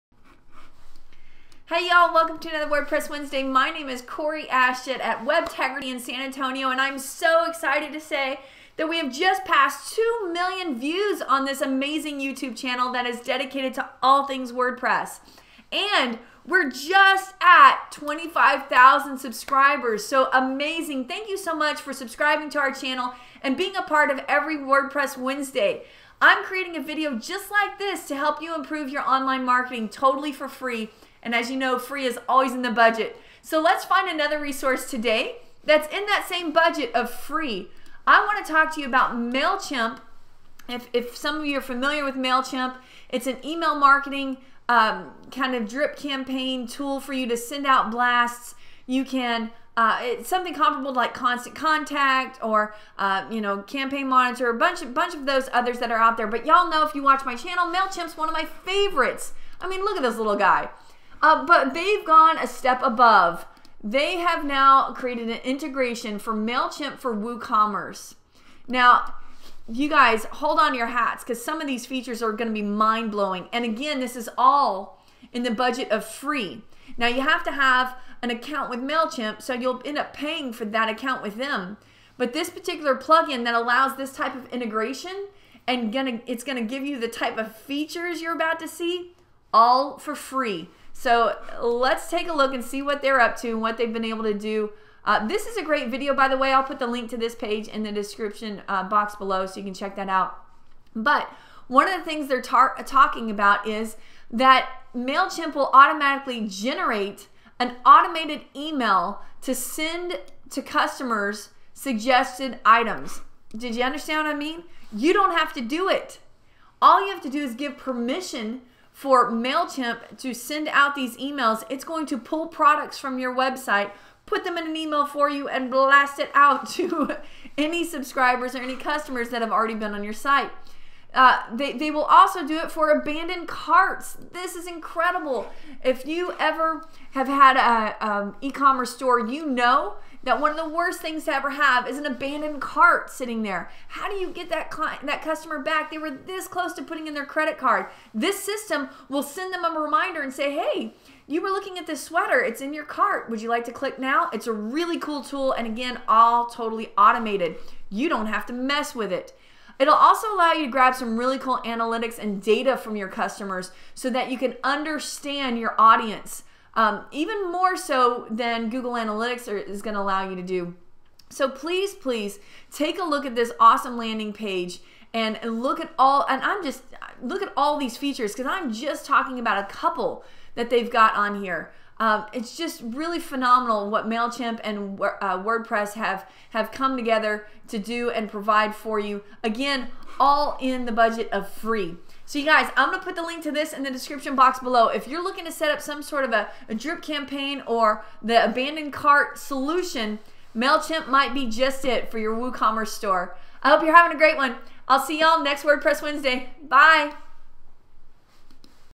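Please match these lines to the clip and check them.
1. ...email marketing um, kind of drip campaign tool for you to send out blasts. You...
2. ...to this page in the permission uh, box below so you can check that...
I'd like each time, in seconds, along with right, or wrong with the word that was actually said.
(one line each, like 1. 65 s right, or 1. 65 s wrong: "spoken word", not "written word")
1. 43 s right
2. 97 s wrong: "description", not "permission".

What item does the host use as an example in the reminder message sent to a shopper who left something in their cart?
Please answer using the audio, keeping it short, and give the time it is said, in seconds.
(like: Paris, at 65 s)
sweater, at 152 s.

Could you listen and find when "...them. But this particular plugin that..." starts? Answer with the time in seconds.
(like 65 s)
81 s.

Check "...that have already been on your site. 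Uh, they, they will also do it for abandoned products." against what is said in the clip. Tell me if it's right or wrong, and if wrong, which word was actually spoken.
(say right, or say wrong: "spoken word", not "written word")
wrong: "carts", not "products".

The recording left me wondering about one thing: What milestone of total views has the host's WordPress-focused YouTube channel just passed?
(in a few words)
2 million.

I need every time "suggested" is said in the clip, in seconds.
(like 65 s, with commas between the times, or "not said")
111 s.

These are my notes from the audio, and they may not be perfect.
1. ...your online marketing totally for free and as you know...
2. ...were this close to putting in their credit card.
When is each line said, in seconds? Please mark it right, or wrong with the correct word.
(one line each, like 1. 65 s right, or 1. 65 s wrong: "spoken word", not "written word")
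1. 28 s right
2. 145 s right.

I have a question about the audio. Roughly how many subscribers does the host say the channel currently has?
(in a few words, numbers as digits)
25,000.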